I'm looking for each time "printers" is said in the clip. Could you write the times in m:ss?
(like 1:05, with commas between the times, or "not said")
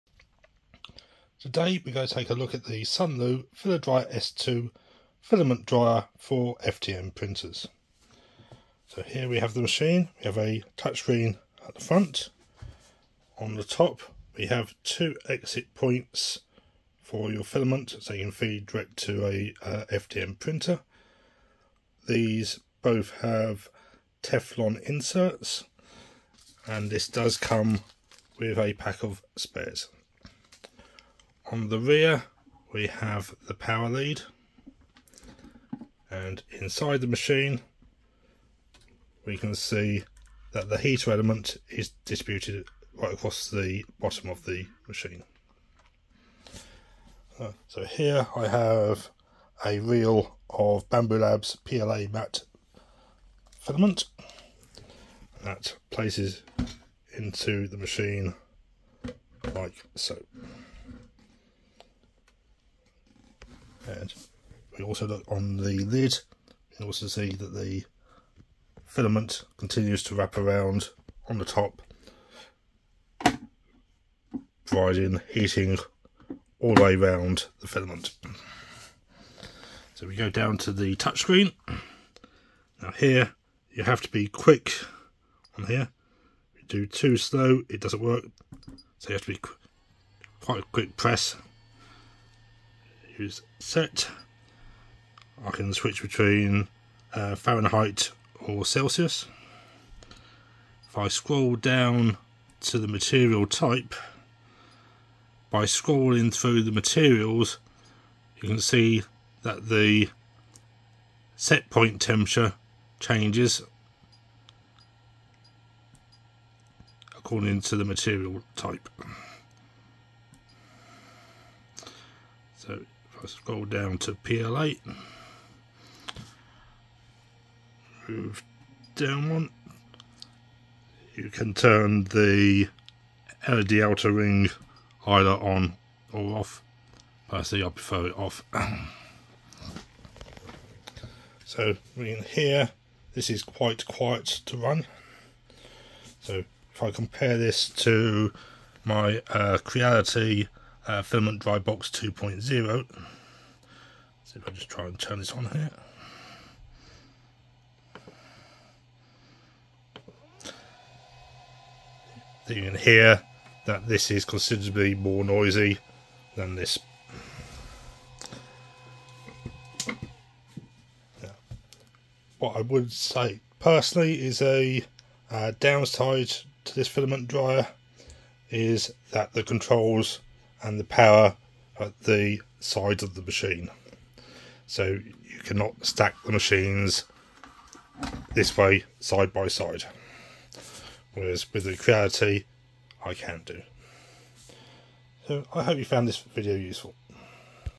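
0:07, 0:20.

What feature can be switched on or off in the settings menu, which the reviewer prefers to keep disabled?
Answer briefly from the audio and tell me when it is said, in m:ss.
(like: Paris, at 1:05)
LED outer ring, at 2:13.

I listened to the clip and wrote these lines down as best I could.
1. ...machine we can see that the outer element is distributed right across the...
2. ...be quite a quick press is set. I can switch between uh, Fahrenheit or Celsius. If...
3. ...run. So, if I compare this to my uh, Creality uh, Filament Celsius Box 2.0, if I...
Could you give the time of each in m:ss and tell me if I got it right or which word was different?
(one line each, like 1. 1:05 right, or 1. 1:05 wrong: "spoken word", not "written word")
1. 0:37 wrong: "heater", not "outer"
2. 1:29 right
3. 2:24 wrong: "Dry", not "Celsius".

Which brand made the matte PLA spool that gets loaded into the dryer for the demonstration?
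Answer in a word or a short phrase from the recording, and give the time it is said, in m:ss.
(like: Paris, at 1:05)
Bambu Labs, at 0:50.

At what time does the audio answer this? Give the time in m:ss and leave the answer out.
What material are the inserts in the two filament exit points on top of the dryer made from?
0:24.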